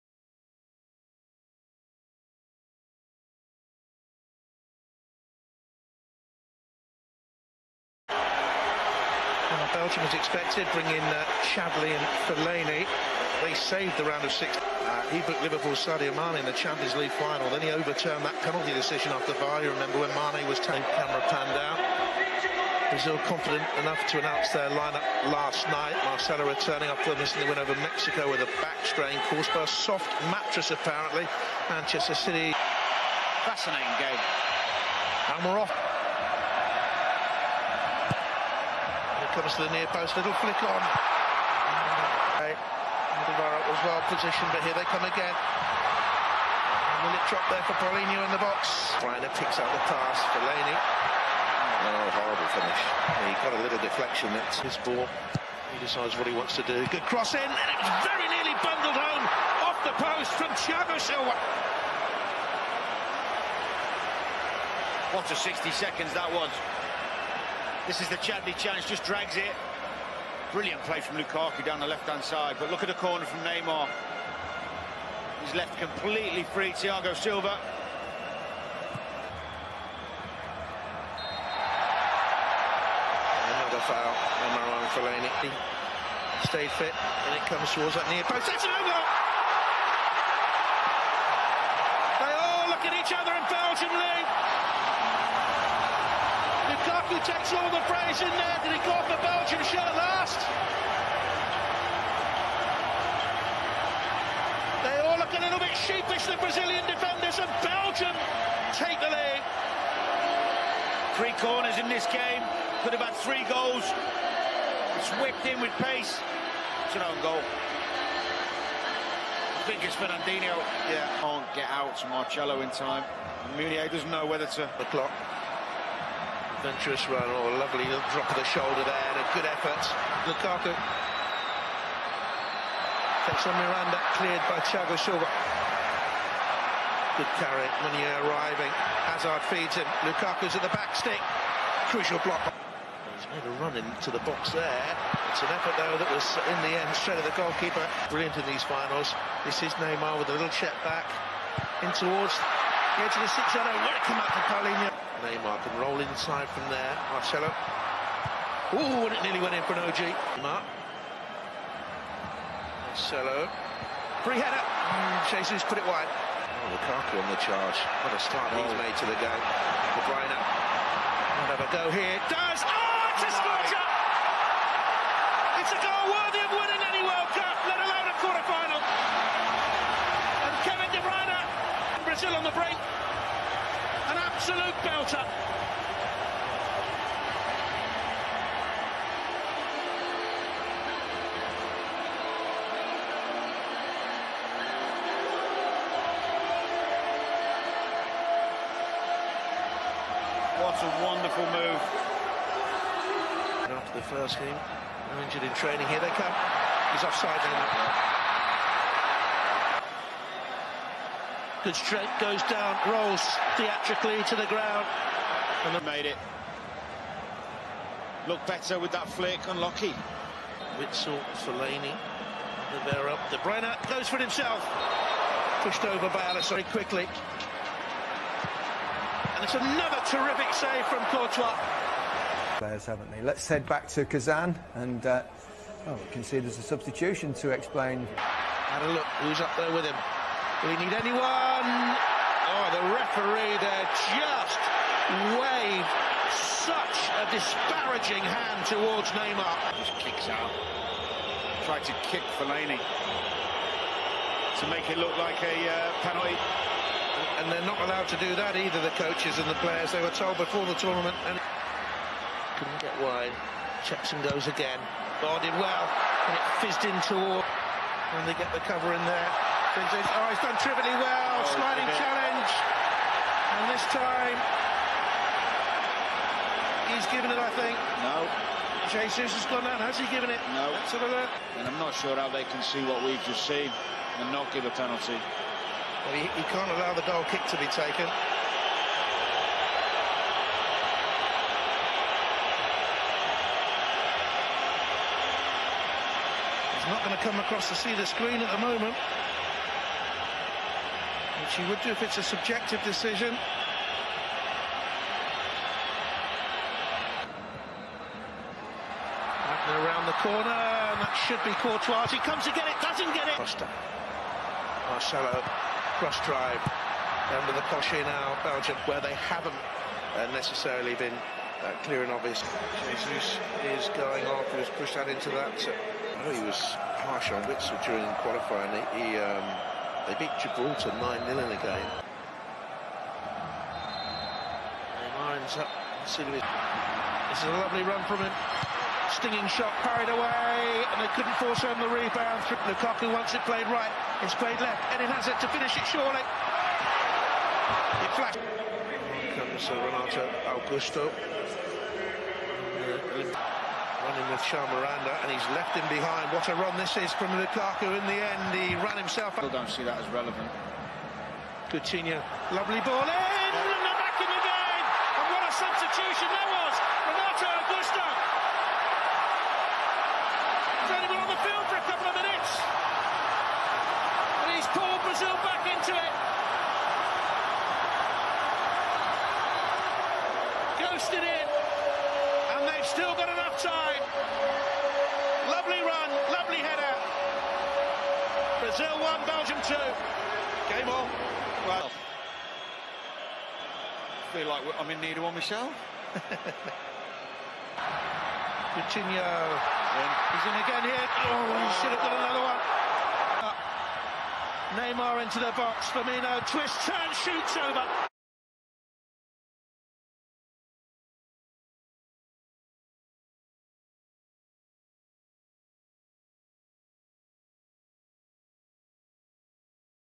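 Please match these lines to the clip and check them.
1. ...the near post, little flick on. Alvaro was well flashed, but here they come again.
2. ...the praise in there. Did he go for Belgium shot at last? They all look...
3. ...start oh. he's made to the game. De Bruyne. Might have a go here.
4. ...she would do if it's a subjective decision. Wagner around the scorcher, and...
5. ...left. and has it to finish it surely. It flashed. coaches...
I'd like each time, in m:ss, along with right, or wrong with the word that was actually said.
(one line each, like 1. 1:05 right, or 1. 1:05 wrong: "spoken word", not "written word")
1. 0:39 wrong: "positioned", not "flashed"
2. 1:37 right
3. 2:48 right
4. 5:01 wrong: "corner", not "scorcher"
5. 5:44 wrong: "comes", not "coaches".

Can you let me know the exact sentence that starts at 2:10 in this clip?
Lukaku takes on Miranda, cleared by Thiago Silva.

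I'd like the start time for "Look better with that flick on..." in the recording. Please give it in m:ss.
3:38.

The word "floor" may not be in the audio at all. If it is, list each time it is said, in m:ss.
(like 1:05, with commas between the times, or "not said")
not said.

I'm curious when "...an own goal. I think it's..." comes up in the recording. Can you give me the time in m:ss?
1:56.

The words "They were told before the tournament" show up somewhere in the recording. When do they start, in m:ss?
4:19.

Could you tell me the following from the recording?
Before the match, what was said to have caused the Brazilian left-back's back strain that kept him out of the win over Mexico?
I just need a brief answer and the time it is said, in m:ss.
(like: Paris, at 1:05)
A soft mattress, at 0:29.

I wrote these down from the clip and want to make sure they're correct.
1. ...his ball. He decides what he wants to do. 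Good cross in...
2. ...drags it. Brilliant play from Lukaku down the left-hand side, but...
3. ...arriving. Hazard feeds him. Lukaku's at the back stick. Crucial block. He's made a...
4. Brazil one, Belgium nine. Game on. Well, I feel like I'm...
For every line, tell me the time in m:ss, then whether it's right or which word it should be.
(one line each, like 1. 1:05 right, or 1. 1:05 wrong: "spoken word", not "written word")
1. 0:54 right
2. 1:09 right
3. 2:18 right
4. 6:28 wrong: "two", not "nine".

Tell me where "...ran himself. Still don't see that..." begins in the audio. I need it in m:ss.
5:58.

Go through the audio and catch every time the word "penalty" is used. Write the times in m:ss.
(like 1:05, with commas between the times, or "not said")
0:18, 4:16, 4:44.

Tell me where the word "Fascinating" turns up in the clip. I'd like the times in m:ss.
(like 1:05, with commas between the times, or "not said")
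0:33.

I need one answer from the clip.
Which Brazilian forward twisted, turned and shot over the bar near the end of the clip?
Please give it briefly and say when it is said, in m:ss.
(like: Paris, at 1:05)
Firmino, at 6:45.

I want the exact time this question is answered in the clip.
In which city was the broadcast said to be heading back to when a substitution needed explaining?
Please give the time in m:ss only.
3:54.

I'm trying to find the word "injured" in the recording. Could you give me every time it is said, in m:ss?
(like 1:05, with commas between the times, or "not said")
3:25.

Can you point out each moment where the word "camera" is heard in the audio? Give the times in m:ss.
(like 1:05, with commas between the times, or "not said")
0:20.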